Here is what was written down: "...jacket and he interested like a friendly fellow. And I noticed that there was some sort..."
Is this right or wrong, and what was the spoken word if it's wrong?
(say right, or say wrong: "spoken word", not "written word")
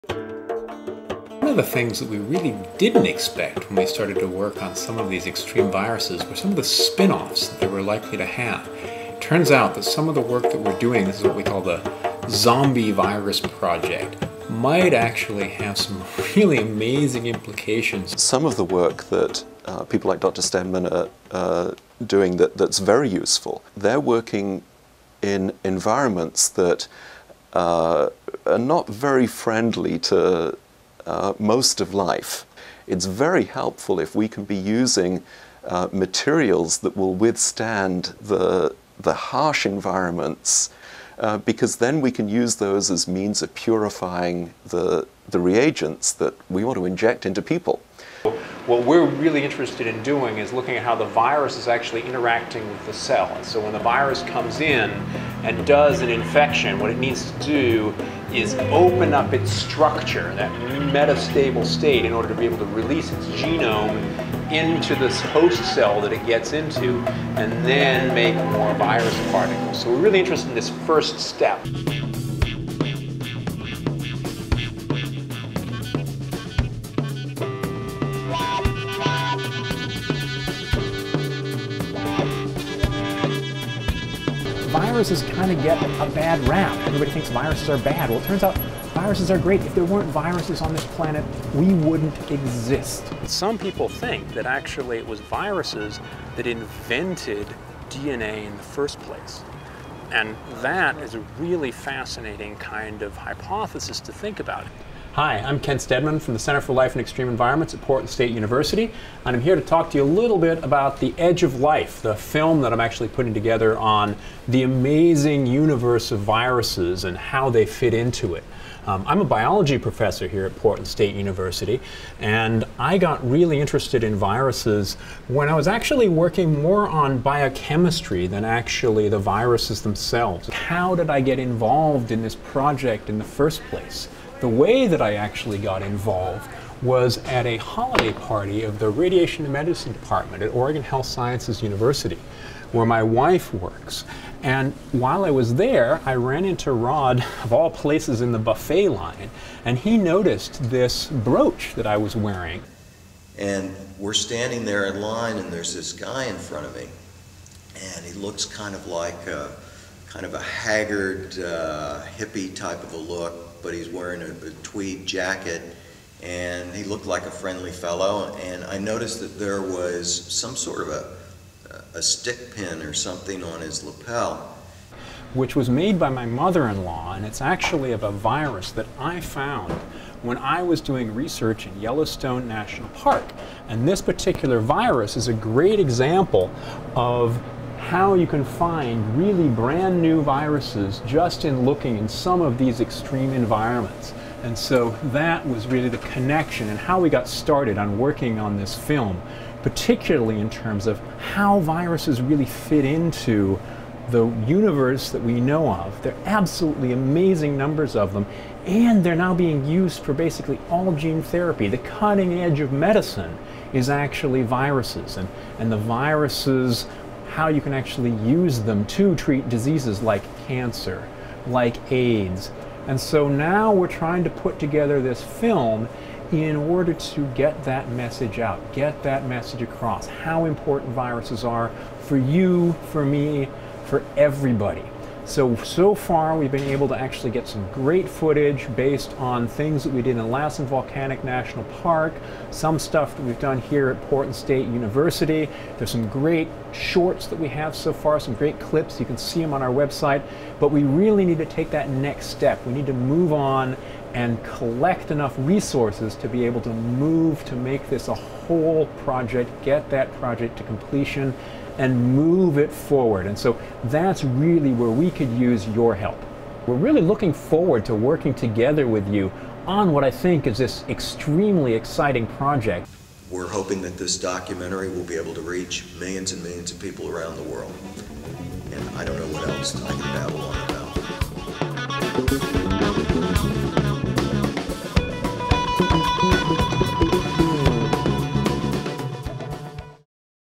wrong: "looked", not "interested".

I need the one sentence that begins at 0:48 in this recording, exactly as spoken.
What we're really interested in doing is looking at how the virus is actually interacting with the cell.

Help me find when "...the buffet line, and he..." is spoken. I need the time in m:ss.
2:28.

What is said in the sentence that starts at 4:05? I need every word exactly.
There's some great shorts that we have so far, some great clips.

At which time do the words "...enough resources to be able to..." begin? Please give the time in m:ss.
4:15.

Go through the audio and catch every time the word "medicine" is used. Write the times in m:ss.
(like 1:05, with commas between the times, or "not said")
2:19, 3:32.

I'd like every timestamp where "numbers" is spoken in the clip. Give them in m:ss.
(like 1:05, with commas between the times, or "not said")
3:27.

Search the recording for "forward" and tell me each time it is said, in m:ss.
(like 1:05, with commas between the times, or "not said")
4:22, 4:27.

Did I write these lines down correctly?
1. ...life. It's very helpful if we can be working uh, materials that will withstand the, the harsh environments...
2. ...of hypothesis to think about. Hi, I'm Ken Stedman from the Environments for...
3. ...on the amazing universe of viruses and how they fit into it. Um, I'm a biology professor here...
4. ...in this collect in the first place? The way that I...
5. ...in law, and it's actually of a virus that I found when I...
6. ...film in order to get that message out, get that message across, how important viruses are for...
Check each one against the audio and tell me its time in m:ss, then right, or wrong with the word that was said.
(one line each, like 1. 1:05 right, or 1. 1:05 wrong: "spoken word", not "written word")
1. 0:31 wrong: "using", not "working"
2. 1:43 wrong: "Center", not "Environments"
3. 1:53 right
4. 2:12 wrong: "project", not "collect"
5. 2:56 right
6. 3:45 right.